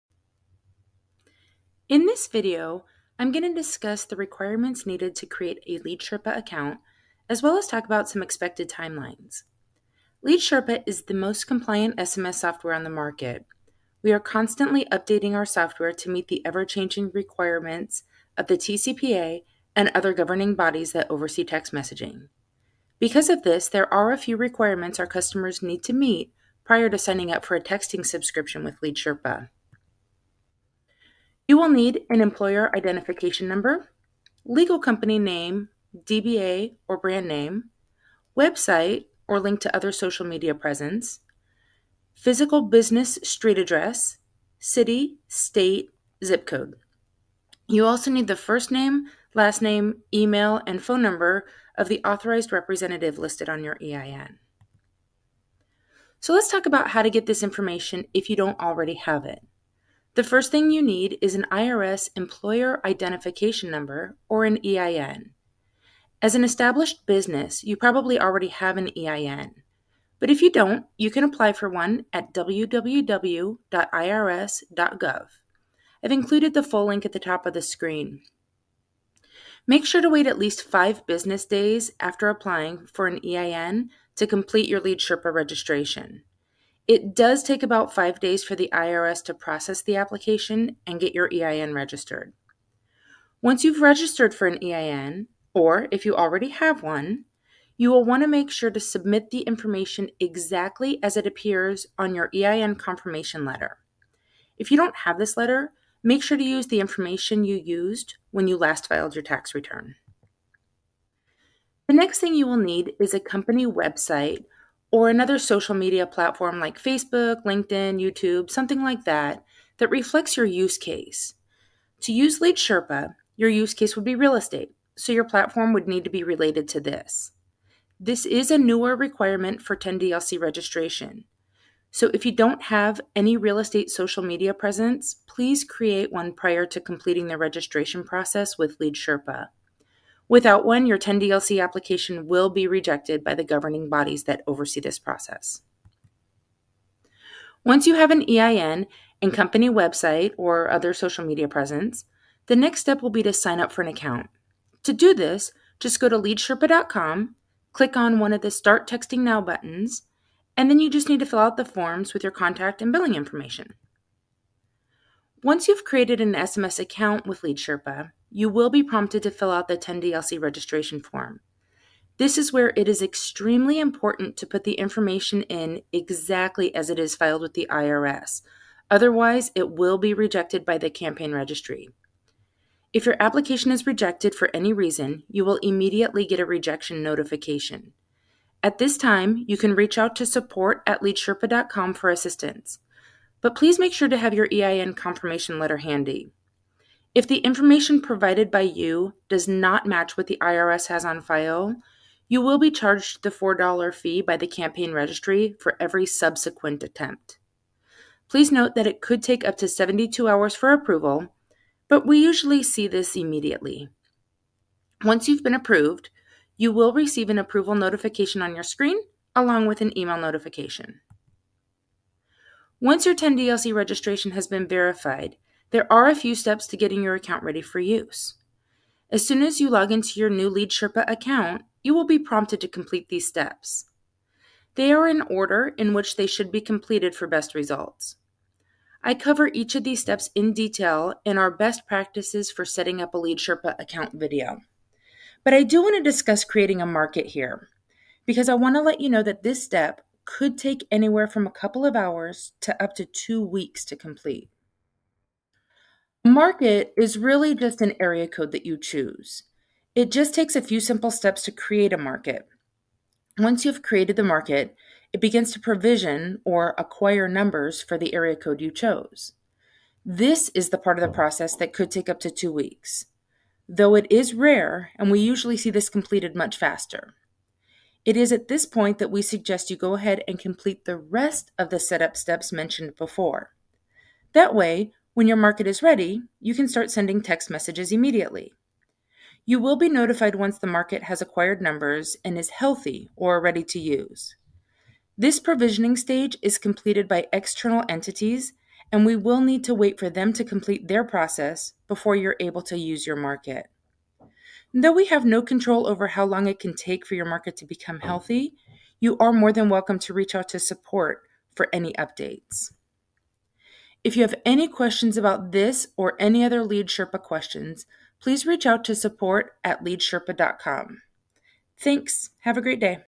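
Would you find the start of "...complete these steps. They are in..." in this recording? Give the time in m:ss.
3:52.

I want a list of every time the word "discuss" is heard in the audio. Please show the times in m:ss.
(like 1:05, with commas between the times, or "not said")
0:03, 4:06.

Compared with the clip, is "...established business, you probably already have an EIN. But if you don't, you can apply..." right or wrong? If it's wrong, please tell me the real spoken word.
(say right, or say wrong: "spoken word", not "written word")
right.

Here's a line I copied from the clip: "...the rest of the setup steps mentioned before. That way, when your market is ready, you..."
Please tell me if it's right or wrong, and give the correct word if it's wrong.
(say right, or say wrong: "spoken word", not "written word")
right.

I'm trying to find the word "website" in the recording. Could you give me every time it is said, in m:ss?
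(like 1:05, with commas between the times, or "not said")
0:38, 1:53, 2:29.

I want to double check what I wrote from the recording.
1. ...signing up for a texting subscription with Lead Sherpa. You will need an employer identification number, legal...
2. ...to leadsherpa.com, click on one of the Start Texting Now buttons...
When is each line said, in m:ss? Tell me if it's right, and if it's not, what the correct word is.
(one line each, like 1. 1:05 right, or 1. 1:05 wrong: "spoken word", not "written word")
1. 0:26 right
2. 2:36 right.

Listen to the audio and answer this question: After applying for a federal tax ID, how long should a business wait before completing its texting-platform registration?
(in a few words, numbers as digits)
5 business days.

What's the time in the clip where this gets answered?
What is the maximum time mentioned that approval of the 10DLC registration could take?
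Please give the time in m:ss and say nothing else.
3:29.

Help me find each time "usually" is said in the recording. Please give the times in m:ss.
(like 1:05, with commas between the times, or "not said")
3:32, 4:35.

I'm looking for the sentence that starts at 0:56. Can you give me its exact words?
So let's talk about how to get this information if you don't already have it.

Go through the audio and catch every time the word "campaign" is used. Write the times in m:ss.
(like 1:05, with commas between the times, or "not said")
3:00, 3:24.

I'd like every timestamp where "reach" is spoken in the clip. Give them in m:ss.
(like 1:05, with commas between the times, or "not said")
3:09, 5:10, 5:18.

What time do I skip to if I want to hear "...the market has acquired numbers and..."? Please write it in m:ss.
4:50.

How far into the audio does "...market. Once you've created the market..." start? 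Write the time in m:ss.
4:21.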